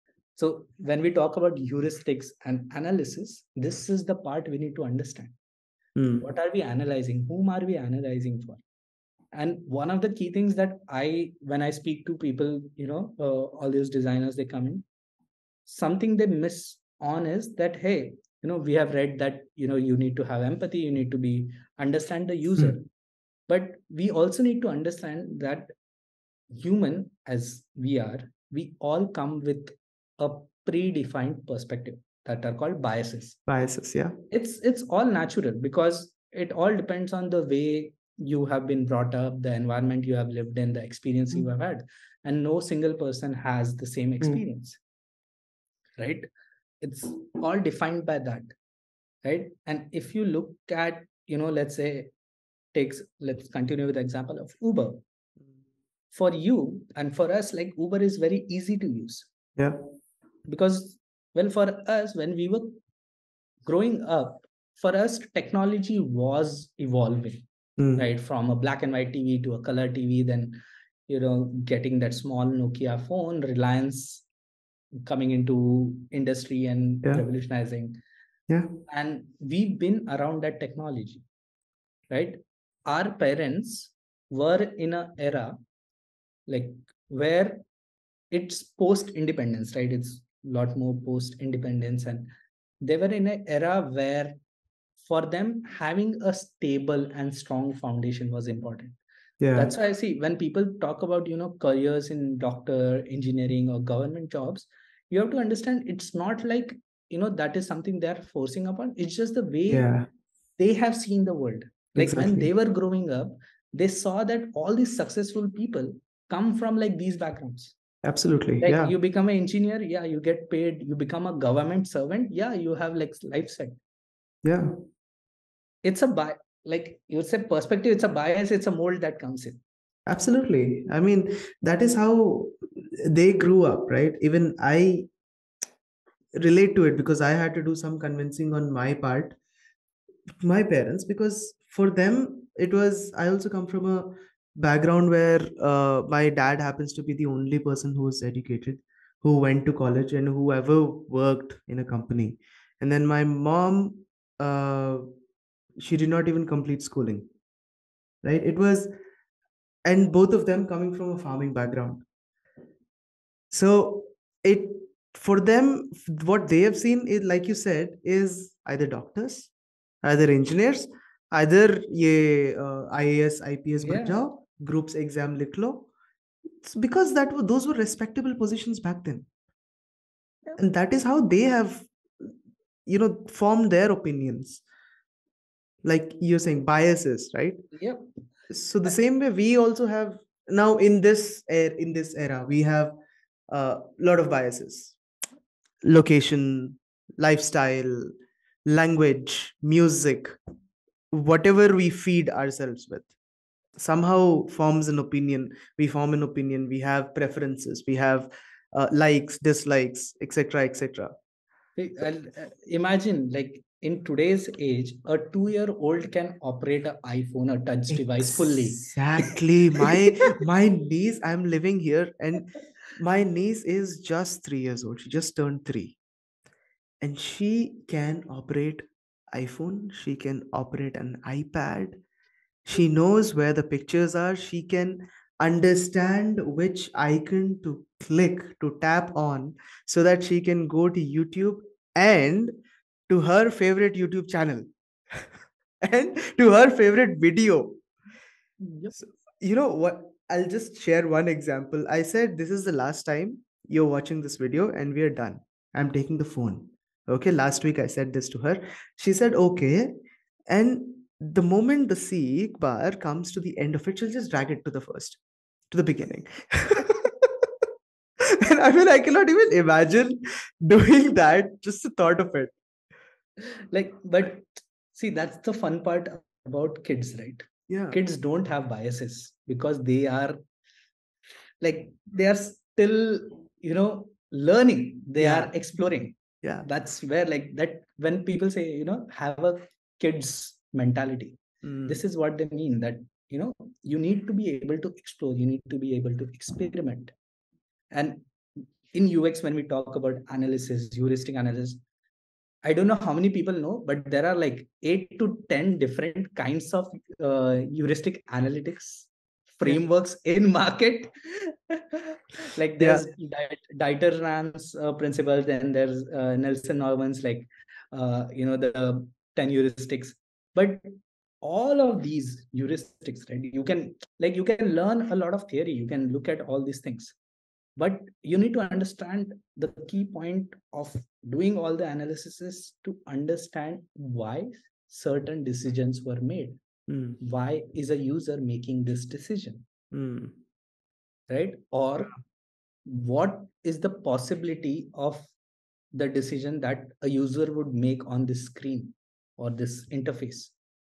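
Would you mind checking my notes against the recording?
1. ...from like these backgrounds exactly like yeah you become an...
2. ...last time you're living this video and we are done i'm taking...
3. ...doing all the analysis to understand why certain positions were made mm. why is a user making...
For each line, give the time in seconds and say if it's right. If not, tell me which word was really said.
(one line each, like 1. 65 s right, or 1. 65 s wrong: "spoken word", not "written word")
1. 116 s wrong: "absolutely", not "exactly"
2. 252 s wrong: "watching", not "living"
3. 331 s wrong: "decisions", not "positions".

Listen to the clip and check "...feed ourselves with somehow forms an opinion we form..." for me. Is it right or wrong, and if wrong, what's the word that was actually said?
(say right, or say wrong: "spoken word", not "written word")
right.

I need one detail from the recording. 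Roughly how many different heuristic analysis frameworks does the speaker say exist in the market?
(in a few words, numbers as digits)
8 to 10.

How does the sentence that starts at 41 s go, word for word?
you have had and no single person has the same mm.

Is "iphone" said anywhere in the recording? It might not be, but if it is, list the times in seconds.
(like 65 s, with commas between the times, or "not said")
217 s, 229 s.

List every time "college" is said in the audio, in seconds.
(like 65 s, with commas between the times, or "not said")
149 s.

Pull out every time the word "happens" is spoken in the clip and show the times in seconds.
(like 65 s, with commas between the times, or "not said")
146 s.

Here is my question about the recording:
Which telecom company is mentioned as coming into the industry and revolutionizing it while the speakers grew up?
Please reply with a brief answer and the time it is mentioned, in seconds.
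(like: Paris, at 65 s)
Reliance, at 73 s.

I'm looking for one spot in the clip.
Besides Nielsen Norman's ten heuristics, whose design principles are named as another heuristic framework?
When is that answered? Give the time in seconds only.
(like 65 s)
313 s.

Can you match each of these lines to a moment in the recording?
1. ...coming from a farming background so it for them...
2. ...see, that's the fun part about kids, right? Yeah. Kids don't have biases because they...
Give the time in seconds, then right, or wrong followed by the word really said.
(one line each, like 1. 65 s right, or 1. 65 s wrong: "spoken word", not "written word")
1. 160 s right
2. 274 s right.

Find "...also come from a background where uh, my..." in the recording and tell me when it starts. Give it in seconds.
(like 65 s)
143 s.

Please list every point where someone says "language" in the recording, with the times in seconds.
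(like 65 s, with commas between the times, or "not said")
198 s.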